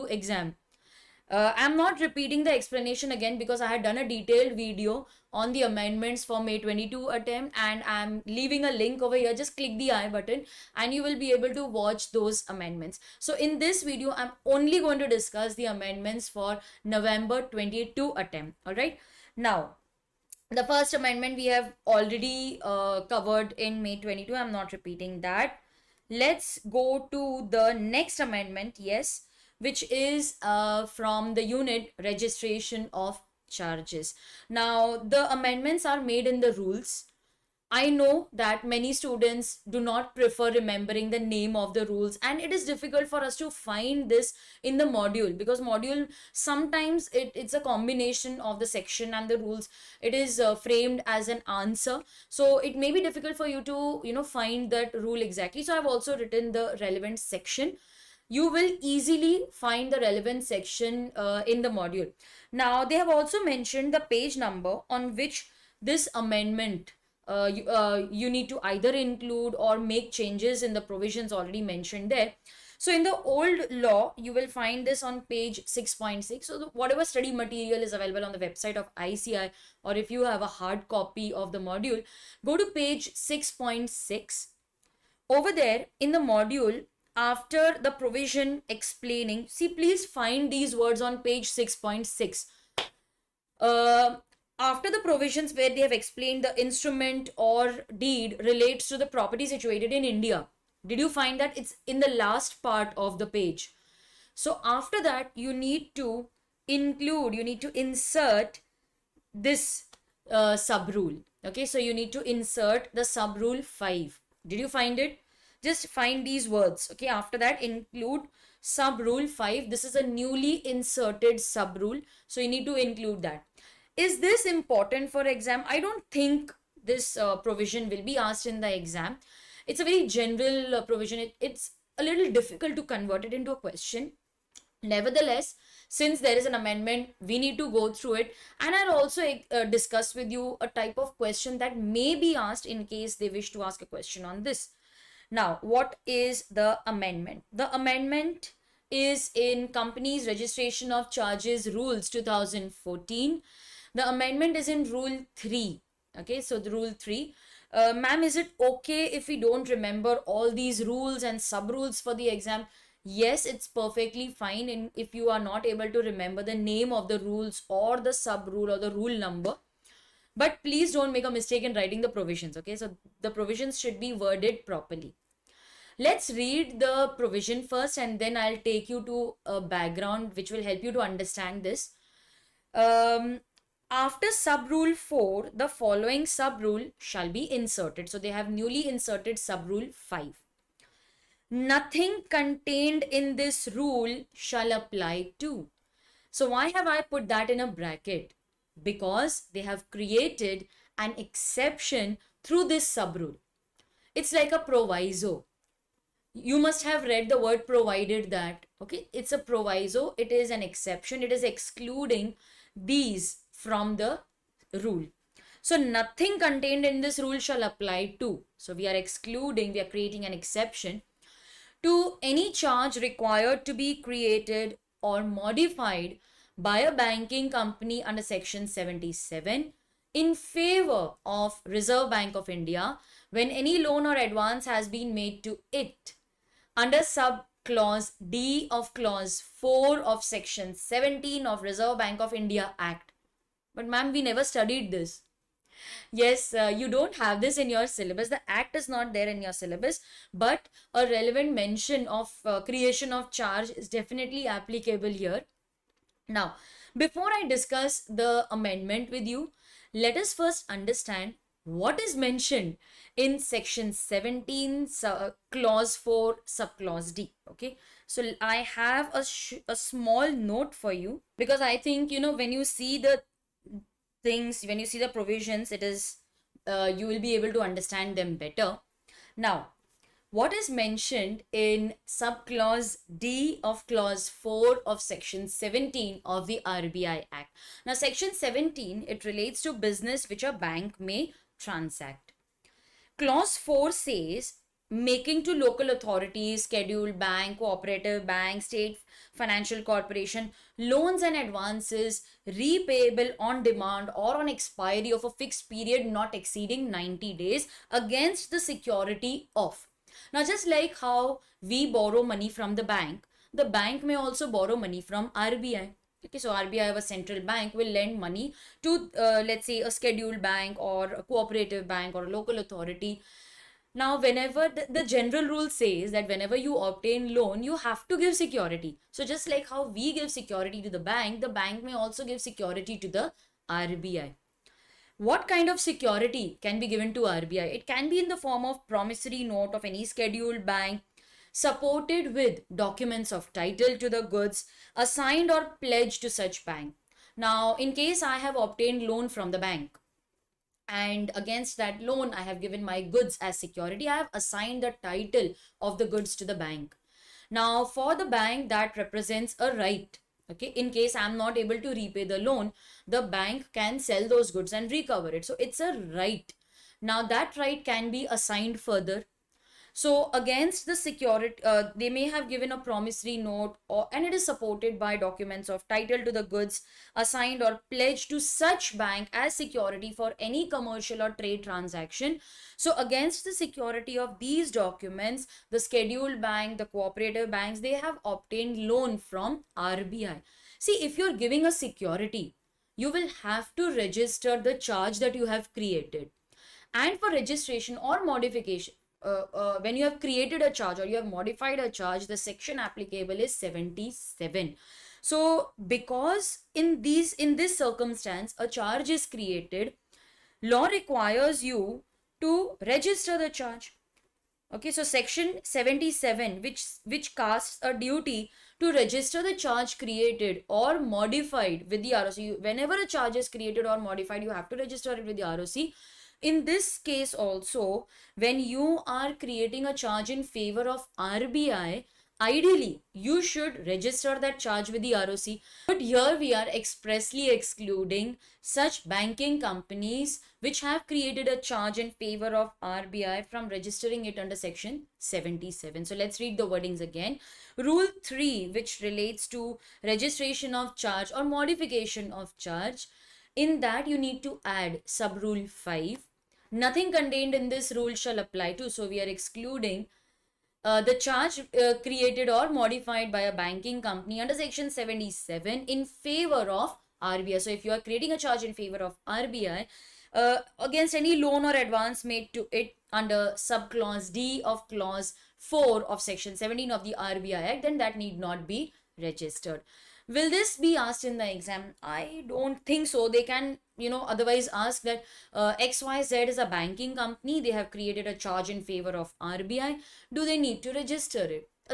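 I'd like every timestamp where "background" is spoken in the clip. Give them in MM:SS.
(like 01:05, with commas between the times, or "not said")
02:59.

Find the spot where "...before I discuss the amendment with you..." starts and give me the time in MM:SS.
04:16.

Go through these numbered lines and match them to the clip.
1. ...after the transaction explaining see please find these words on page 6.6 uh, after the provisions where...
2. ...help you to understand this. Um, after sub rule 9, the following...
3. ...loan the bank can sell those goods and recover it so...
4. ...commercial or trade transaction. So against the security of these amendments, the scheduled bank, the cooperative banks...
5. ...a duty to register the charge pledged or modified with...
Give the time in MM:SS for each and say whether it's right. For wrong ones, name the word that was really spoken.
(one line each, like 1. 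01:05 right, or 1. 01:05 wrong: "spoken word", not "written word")
1. 01:27 wrong: "provision", not "transaction"
2. 03:00 wrong: "4", not "9"
3. 06:02 right
4. 06:20 wrong: "documents", not "amendments"
5. 06:57 wrong: "created", not "pledged".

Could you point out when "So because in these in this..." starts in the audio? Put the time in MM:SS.
06:45.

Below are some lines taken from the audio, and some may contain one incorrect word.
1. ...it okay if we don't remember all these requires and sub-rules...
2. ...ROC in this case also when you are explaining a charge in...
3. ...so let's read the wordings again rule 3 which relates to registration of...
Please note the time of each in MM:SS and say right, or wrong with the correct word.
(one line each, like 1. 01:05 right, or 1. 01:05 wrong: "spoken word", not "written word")
1. 02:38 wrong: "rules", not "requires"
2. 07:05 wrong: "creating", not "explaining"
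3. 07:26 right.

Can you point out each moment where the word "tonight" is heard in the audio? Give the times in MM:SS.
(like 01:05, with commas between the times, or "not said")
not said.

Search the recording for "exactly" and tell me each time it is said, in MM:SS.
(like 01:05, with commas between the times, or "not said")
00:55.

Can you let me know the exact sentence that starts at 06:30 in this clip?
See, if you're giving a security, you will have to register the charge that you have created.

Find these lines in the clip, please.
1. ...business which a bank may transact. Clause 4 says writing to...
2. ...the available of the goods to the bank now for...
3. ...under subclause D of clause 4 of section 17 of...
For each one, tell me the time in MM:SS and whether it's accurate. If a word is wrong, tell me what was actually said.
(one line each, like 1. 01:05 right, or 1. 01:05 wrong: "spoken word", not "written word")
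1. 04:49 wrong: "making", not "writing"
2. 05:54 wrong: "title", not "available"
3. 07:53 right.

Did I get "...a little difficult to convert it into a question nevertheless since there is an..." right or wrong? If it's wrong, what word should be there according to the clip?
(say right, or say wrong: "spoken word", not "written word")
right.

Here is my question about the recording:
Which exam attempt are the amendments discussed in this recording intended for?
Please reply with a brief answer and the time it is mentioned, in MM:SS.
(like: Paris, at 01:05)
November 22, at 00:16.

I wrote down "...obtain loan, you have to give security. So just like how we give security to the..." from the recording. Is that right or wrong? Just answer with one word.
right.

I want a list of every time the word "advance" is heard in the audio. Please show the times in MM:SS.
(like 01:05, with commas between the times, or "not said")
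03:54, 05:01, 07:51.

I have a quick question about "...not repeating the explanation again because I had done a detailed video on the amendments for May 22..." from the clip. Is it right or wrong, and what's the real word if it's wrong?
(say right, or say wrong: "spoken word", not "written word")
right.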